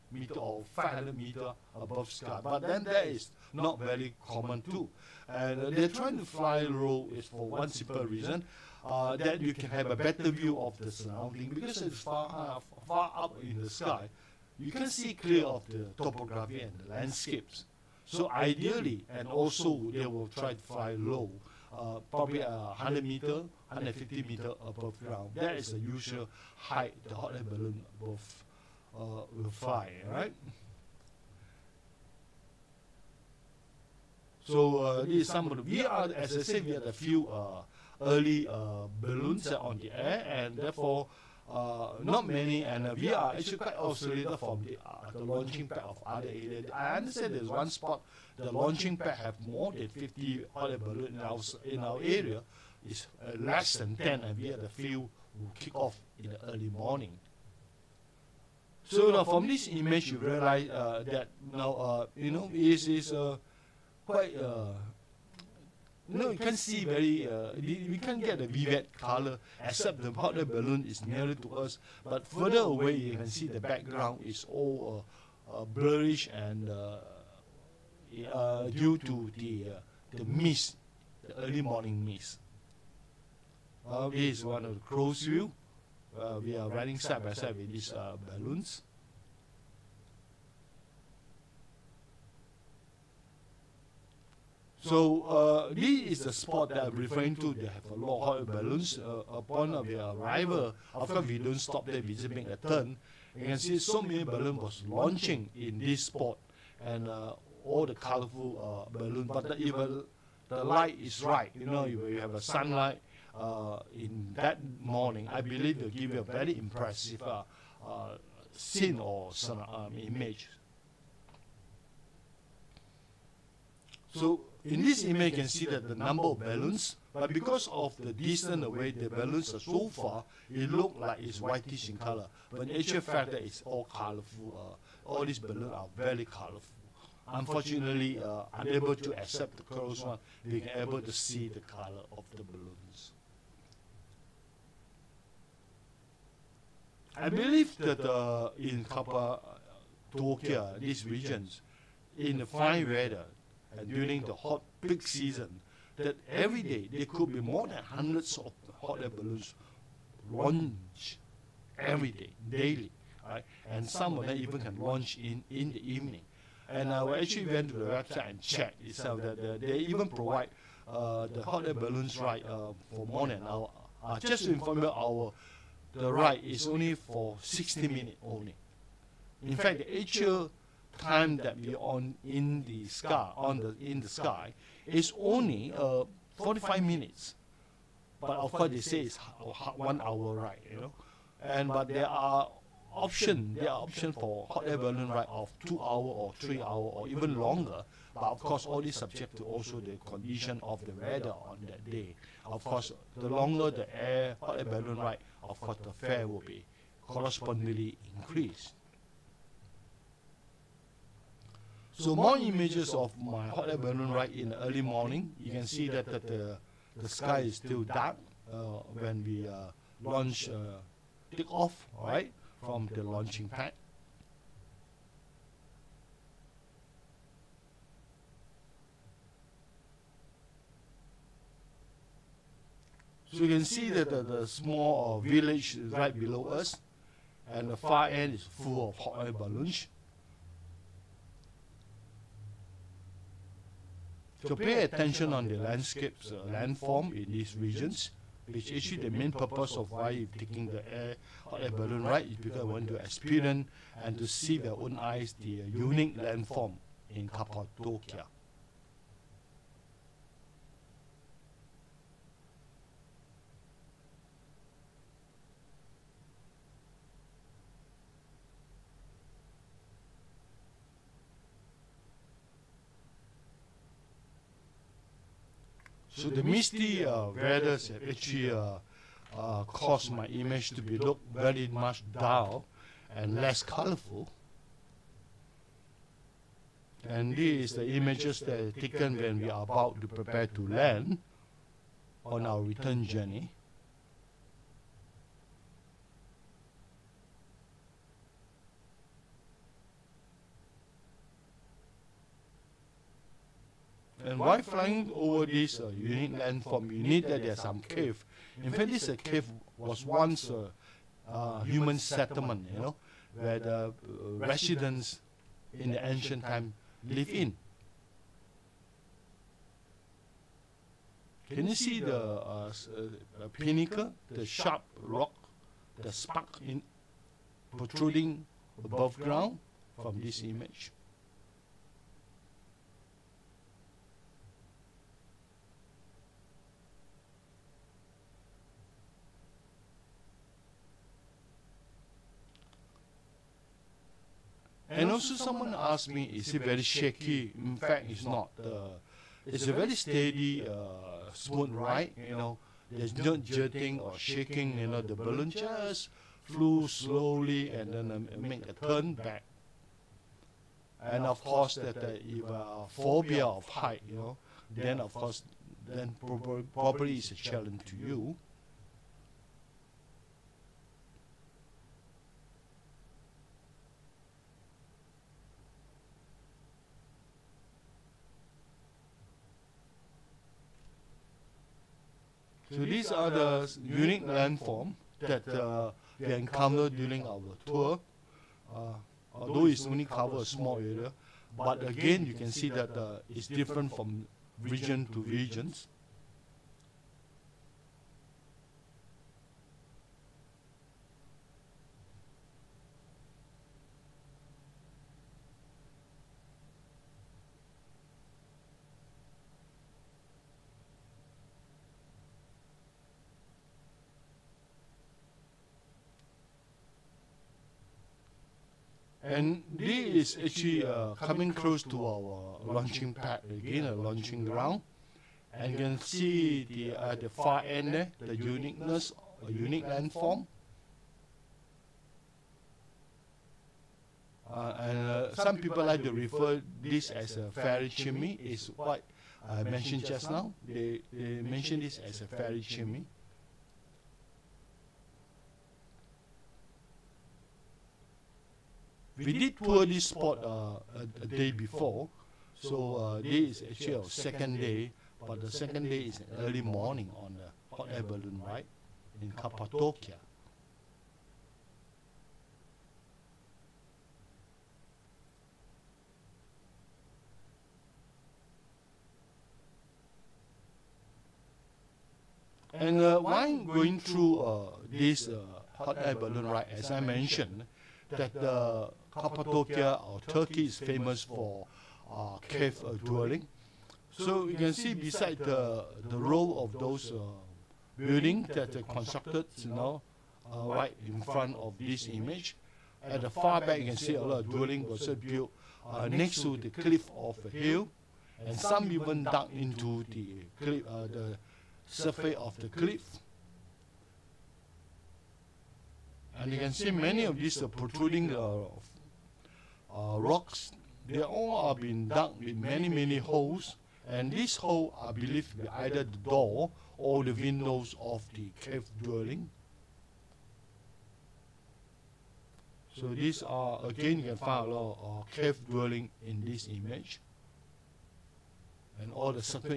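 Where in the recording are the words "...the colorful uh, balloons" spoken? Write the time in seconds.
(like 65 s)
107 s.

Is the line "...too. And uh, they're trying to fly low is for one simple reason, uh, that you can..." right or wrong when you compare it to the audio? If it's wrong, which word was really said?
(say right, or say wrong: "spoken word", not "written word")
right.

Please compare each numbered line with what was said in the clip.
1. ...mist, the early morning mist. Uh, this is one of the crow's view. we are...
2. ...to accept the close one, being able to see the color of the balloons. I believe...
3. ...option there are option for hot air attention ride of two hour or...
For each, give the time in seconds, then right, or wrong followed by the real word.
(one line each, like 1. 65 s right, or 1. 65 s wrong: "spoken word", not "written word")
1. 80 s right
2. 138 s right
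3. 192 s wrong: "balloon", not "attention".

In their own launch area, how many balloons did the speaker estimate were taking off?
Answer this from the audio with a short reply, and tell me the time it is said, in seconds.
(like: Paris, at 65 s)
less than 10, at 53 s.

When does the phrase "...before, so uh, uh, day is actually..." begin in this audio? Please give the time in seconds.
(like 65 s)
451 s.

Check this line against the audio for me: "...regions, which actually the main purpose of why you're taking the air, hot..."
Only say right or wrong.
right.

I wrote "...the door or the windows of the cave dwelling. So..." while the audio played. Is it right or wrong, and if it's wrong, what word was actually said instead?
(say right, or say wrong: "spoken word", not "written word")
right.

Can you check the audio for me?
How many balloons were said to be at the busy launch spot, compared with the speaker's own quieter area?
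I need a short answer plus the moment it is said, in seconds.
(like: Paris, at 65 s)
more than 50, at 49 s.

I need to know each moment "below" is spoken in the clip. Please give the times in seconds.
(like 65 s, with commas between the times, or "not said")
236 s.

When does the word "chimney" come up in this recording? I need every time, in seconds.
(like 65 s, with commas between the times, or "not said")
437 s, 442 s.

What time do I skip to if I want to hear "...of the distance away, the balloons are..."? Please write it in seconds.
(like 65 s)
127 s.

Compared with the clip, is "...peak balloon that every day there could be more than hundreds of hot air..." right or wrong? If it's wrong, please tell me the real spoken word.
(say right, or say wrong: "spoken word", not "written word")
wrong: "season", not "balloon".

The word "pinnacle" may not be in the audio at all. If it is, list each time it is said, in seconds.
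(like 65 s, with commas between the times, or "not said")
323 s.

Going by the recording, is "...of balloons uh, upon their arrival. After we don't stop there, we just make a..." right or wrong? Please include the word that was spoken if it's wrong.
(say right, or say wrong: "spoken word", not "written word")
right.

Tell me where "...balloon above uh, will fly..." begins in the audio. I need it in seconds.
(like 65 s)
27 s.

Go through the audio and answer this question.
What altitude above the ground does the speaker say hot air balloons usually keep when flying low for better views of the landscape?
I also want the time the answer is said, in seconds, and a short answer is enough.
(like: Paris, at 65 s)
100 to 150 meters, at 22 s.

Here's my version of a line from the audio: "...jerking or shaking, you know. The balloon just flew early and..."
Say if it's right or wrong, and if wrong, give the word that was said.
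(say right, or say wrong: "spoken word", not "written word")
wrong: "slowly", not "early".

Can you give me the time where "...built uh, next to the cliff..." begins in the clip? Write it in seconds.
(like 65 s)
495 s.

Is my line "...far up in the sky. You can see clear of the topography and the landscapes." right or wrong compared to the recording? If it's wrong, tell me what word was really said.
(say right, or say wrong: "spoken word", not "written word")
right.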